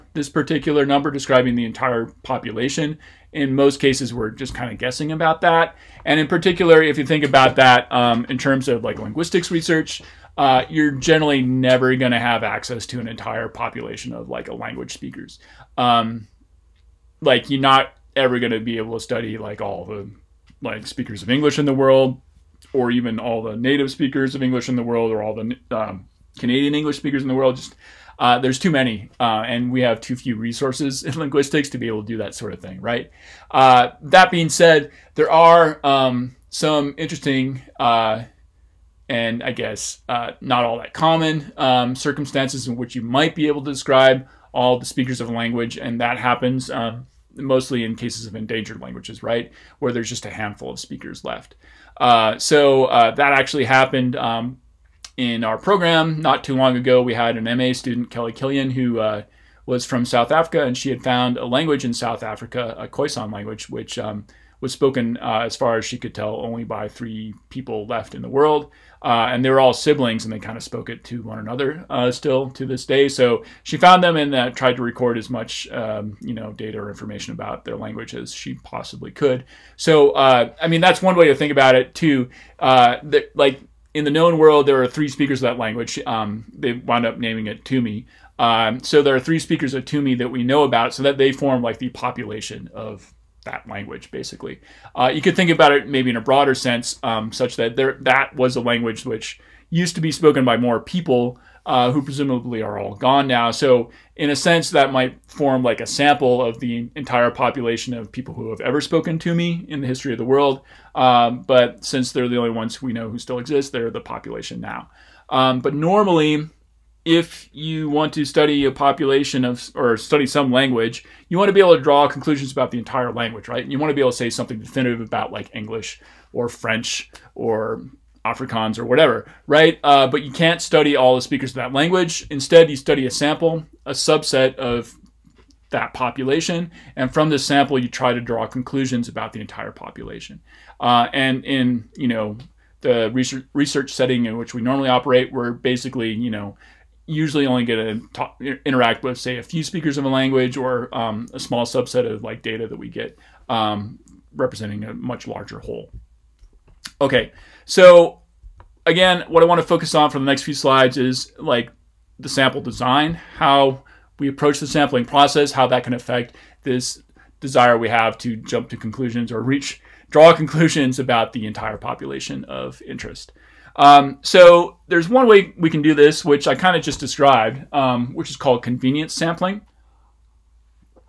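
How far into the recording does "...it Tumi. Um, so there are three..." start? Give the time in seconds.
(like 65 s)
87 s.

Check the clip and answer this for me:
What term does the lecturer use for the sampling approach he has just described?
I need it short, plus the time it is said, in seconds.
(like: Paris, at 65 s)
convenience sampling, at 178 s.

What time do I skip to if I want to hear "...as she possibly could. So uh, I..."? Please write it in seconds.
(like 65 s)
78 s.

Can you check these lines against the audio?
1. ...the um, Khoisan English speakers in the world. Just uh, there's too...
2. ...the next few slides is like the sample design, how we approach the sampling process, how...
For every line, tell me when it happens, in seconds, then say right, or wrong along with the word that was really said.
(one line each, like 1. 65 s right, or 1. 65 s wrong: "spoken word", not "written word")
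1. 25 s wrong: "Canadian", not "Khoisan"
2. 160 s right.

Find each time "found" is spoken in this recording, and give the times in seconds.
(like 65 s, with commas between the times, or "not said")
61 s, 73 s.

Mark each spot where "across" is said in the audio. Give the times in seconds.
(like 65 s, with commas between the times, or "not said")
not said.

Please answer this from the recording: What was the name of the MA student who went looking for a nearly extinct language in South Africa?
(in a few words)
Kelly Killian.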